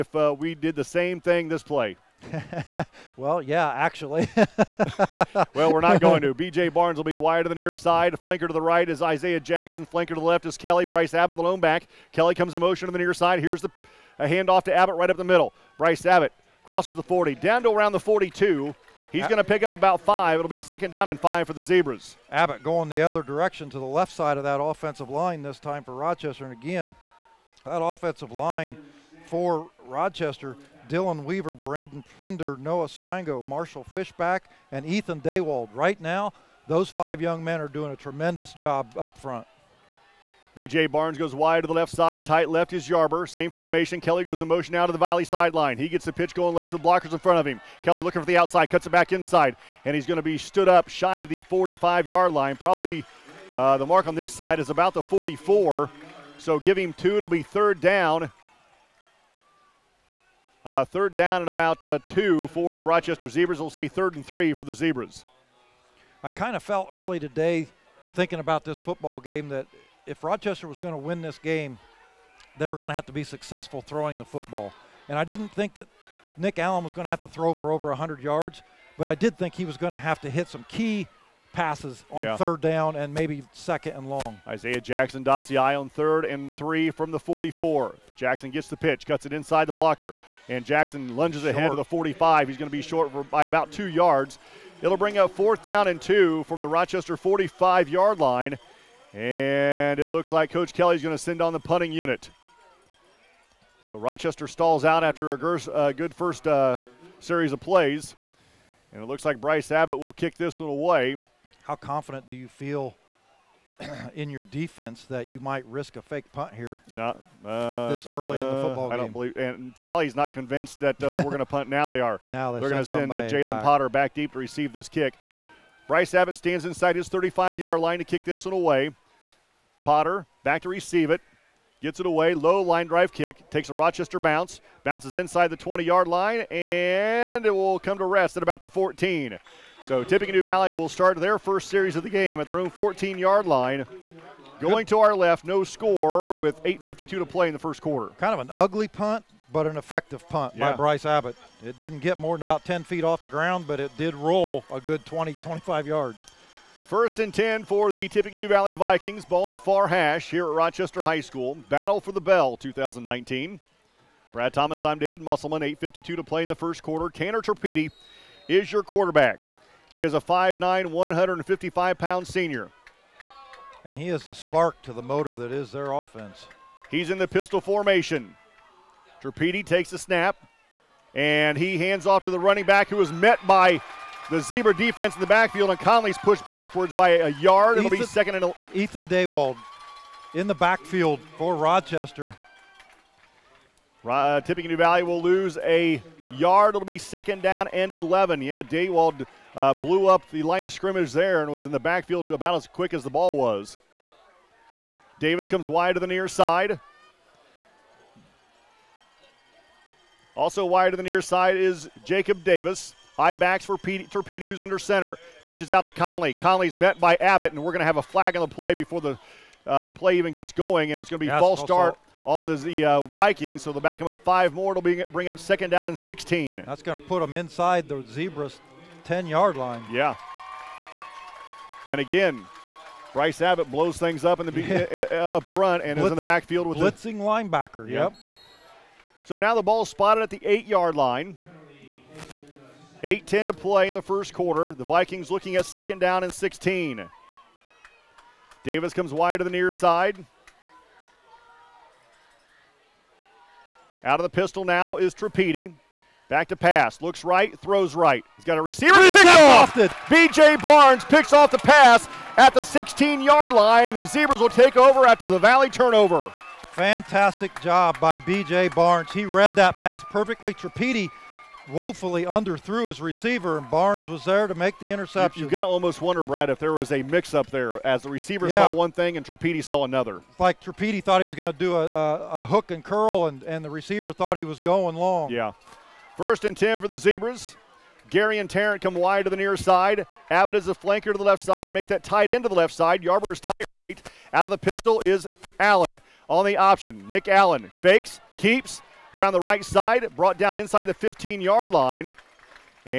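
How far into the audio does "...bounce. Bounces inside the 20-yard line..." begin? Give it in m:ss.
2:14.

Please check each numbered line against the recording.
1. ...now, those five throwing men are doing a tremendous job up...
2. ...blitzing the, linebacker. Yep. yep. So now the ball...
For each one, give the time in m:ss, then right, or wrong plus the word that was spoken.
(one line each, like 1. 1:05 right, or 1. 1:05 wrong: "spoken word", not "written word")
1. 0:36 wrong: "young", not "throwing"
2. 3:56 right.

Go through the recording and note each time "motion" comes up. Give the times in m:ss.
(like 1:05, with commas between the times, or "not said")
0:12, 0:44.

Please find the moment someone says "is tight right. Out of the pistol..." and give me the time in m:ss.
4:53.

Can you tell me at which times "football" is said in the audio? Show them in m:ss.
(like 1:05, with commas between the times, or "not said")
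1:08, 1:14, 1:58.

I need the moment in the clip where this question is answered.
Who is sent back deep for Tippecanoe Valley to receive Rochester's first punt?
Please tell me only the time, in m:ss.
2:03.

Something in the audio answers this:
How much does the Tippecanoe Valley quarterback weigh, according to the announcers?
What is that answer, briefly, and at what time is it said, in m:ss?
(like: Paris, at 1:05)
155 pounds, at 2:50.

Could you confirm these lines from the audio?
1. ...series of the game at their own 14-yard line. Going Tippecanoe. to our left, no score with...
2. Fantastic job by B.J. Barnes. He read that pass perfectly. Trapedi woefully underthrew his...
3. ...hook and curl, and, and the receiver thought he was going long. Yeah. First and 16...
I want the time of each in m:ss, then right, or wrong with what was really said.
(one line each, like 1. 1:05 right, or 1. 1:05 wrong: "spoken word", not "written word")
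1. 2:21 wrong: "Good", not "Tippecanoe"
2. 4:26 right
3. 4:42 wrong: "10", not "16".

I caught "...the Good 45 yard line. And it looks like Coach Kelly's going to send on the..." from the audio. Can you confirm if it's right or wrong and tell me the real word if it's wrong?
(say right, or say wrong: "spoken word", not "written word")
wrong: "Rochester", not "Good".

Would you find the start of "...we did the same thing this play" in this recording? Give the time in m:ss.
0:00.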